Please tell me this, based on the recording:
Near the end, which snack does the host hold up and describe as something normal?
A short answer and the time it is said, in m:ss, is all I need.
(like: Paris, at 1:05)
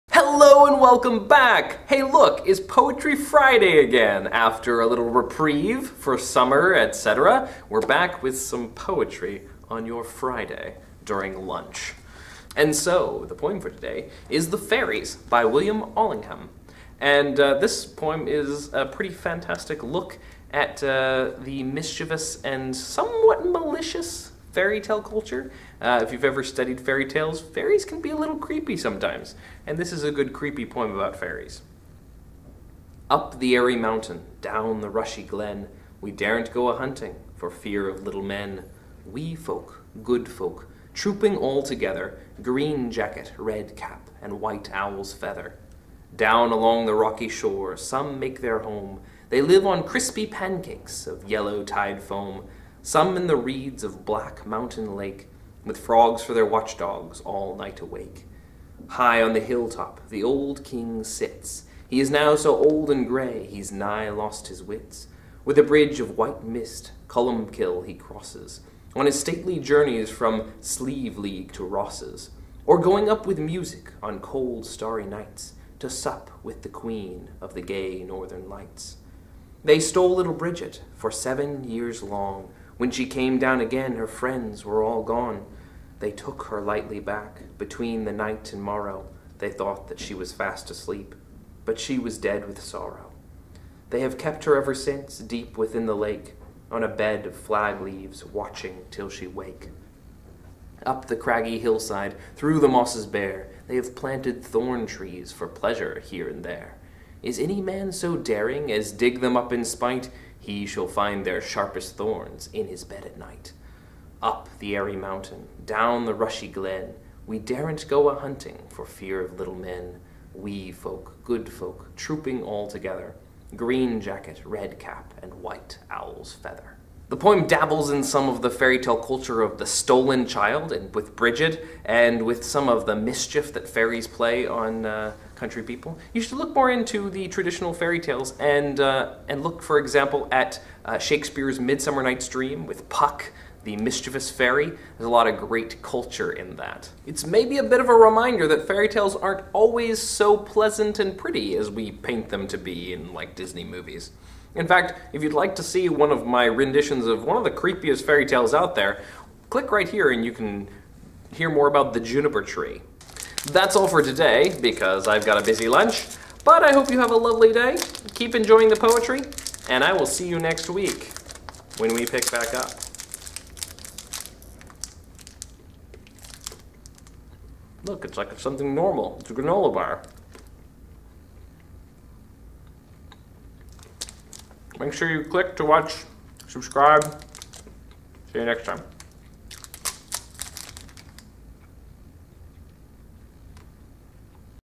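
A granola bar, at 2:59.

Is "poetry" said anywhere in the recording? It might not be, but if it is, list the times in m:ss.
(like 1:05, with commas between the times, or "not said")
0:02, 0:08, 2:48.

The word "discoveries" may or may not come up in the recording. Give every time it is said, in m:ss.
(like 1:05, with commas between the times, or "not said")
not said.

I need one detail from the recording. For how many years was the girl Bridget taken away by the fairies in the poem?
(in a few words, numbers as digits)
7.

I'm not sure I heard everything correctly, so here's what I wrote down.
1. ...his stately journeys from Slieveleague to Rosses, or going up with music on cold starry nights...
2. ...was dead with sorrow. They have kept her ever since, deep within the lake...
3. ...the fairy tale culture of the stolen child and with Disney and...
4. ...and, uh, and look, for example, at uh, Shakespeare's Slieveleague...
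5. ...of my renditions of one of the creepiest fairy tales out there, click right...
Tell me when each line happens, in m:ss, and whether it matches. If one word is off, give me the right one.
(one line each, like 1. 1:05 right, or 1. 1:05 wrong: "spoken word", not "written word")
1. 1:09 right
2. 1:31 right
3. 2:08 wrong: "Bridget", not "Disney"
4. 2:18 wrong: "Midsummer", not "Slieveleague"
5. 2:36 right.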